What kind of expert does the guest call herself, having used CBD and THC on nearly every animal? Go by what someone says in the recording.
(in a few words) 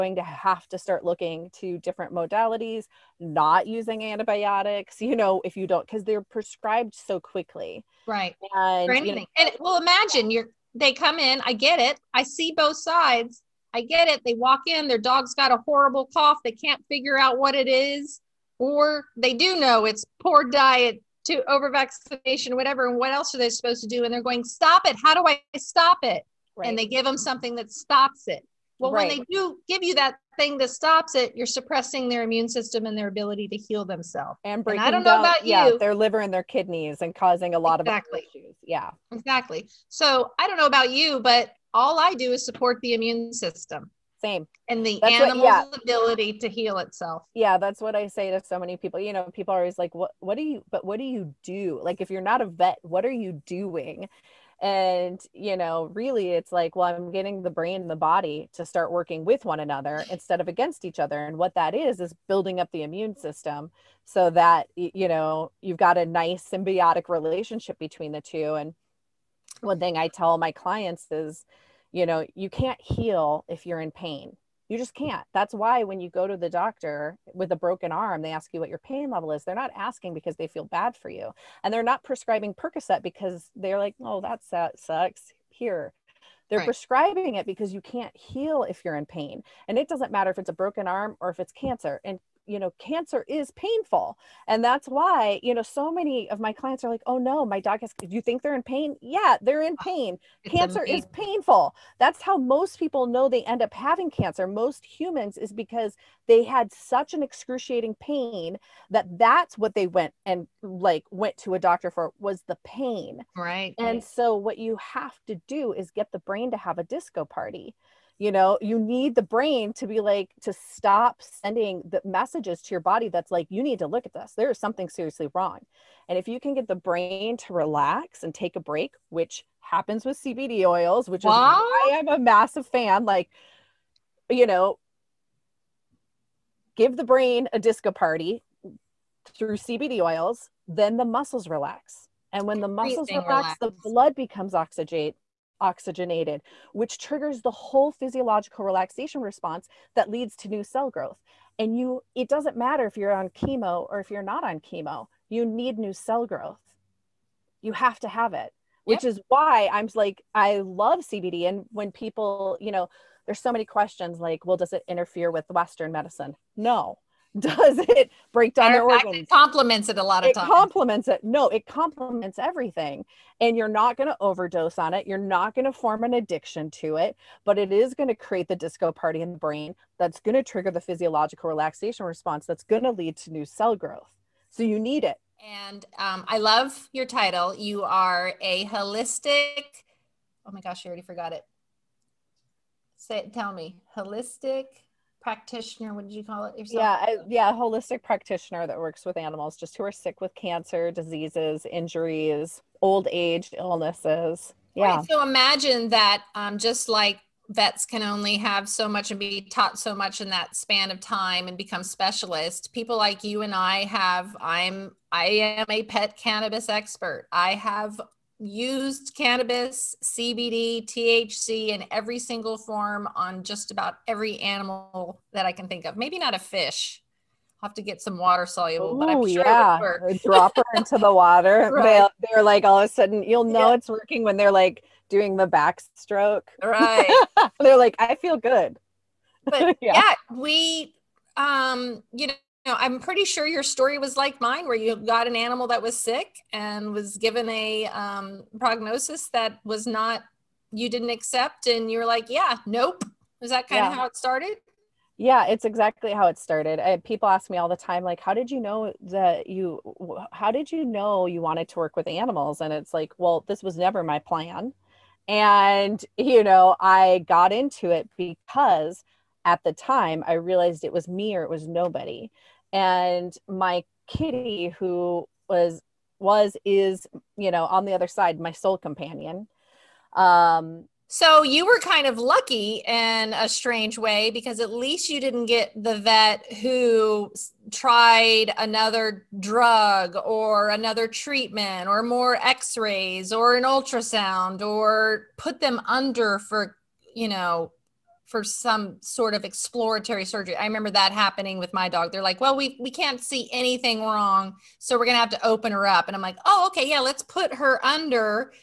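pet cannabis expert.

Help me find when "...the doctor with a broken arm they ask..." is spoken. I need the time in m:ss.
1:16.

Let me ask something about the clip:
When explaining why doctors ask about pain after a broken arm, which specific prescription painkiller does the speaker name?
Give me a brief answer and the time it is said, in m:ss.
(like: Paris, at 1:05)
Percocet, at 1:22.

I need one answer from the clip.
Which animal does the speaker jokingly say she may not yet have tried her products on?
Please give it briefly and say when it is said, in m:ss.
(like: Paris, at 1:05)
a fish, at 3:46.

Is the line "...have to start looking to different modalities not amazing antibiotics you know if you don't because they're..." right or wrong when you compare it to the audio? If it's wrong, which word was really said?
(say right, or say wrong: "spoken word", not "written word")
wrong: "using", not "amazing".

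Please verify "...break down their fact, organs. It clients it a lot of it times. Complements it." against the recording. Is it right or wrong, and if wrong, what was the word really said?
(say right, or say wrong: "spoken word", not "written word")
wrong: "complements", not "clients".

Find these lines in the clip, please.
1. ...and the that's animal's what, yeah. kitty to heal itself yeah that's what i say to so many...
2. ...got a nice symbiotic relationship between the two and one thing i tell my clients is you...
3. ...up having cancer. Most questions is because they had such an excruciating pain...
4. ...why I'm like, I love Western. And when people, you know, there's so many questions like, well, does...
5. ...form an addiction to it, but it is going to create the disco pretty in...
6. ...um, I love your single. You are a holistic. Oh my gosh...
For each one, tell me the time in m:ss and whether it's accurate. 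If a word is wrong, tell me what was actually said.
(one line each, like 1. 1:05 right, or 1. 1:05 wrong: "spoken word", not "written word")
1. 0:44 wrong: "ability", not "kitty"
2. 1:05 right
3. 1:43 wrong: "humans", not "questions"
4. 2:39 wrong: "CBD", not "Western"
5. 2:55 wrong: "party", not "pretty"
6. 3:05 wrong: "title", not "single".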